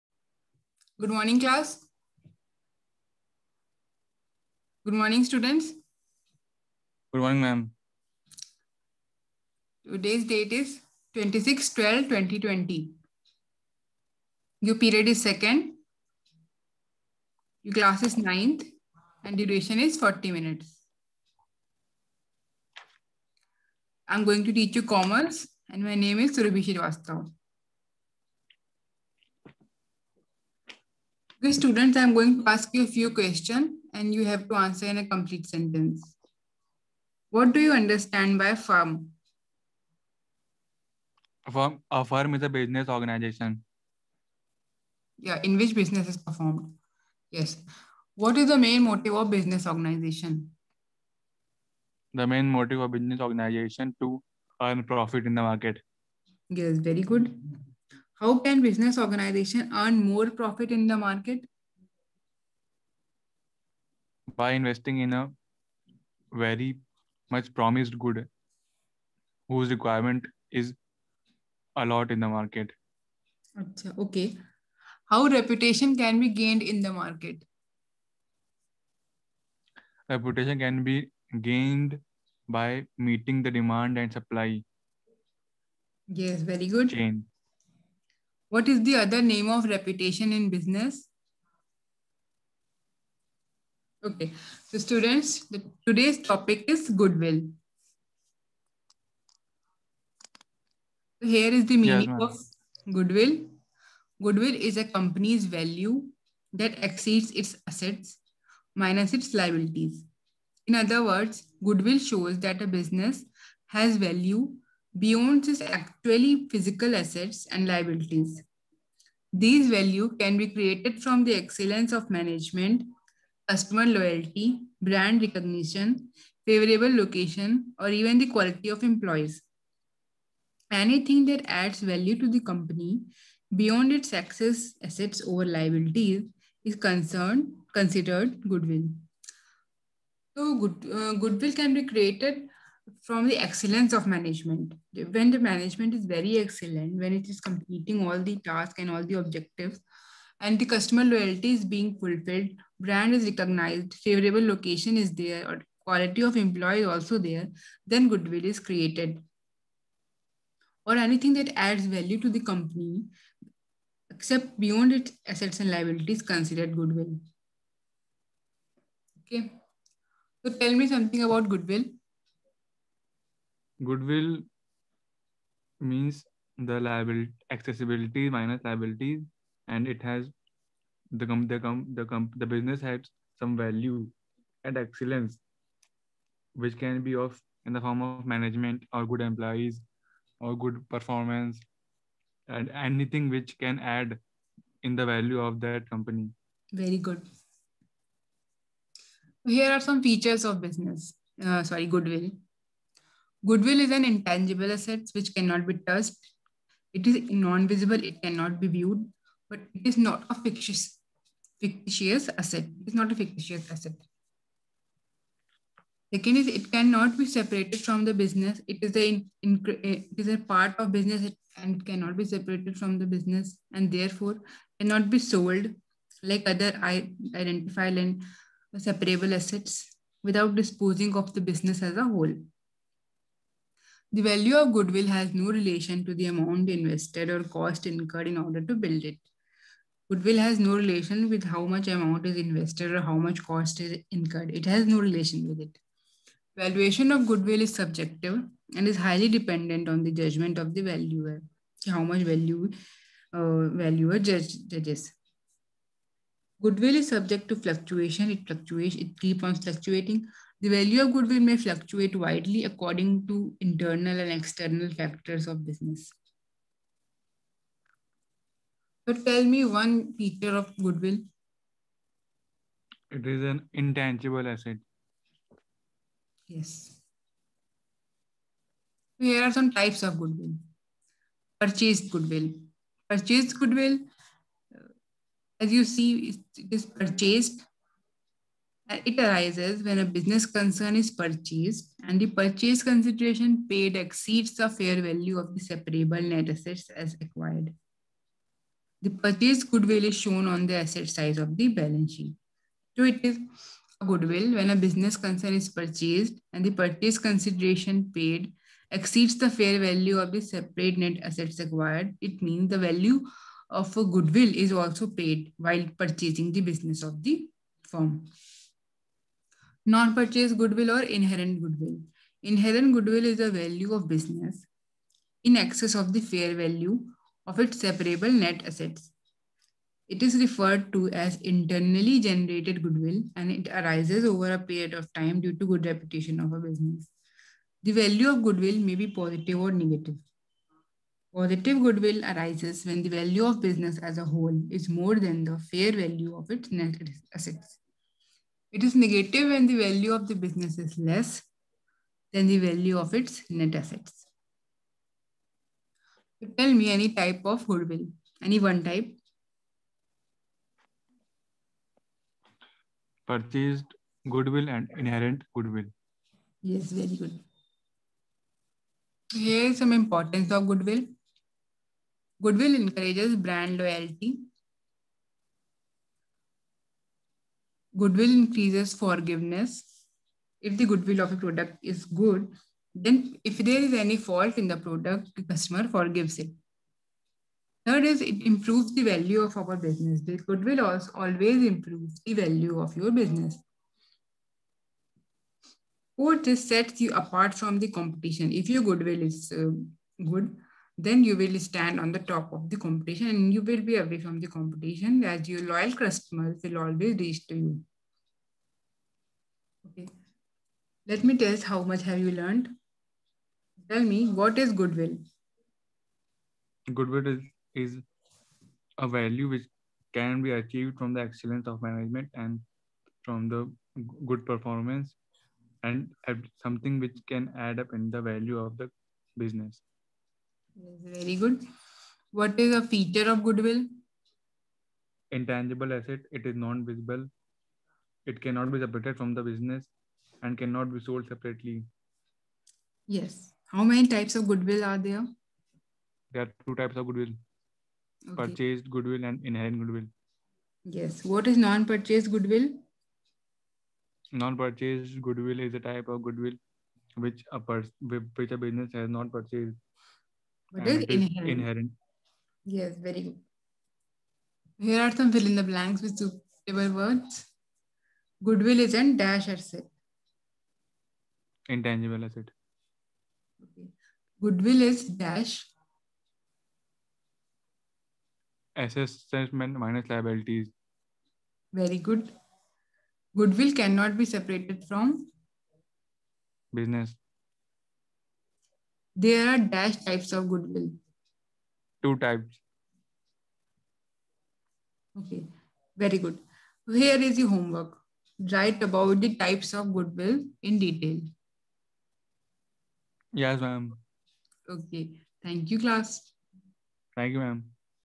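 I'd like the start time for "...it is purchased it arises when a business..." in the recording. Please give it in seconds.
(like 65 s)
286 s.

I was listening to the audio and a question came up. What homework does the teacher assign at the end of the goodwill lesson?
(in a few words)
Types of goodwill in detail.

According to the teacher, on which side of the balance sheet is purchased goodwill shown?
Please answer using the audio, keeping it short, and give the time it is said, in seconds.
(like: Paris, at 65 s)
Asset side, at 300 s.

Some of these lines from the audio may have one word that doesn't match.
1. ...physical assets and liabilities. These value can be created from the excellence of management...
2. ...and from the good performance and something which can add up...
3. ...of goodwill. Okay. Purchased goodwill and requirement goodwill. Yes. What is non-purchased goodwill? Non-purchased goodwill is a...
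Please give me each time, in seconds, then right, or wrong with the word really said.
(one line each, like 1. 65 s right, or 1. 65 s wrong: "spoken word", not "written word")
1. 116 s right
2. 422 s right
3. 446 s wrong: "inherent", not "requirement".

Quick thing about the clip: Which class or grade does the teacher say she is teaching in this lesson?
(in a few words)
Ninth.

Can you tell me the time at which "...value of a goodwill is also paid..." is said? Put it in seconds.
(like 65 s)
312 s.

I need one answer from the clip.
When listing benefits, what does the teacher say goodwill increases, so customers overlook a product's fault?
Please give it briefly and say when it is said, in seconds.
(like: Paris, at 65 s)
Forgiveness, at 378 s.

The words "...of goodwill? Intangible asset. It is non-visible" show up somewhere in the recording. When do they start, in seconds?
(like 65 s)
433 s.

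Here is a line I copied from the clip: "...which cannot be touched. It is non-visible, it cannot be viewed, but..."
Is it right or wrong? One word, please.
right.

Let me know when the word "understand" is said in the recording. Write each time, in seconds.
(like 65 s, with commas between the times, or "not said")
37 s.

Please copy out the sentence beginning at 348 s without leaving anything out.
It is negative when the value of the business is less than the value of its net assets.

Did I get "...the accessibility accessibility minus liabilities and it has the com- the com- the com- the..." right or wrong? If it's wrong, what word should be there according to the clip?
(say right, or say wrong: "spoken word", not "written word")
wrong: "liability", not "accessibility".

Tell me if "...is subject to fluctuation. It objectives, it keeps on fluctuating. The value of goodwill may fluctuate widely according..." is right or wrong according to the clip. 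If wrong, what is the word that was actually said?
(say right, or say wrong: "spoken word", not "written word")
wrong: "fluctuates", not "objectives".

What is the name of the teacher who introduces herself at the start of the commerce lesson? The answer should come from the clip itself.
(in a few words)
Surabhi Srivastava.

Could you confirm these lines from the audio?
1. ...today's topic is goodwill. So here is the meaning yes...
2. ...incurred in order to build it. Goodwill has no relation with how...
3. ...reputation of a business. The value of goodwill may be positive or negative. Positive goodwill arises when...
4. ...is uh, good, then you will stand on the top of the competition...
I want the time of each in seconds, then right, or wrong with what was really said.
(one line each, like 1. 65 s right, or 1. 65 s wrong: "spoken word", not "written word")
1. 95 s right
2. 237 s right
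3. 335 s right
4. 399 s right.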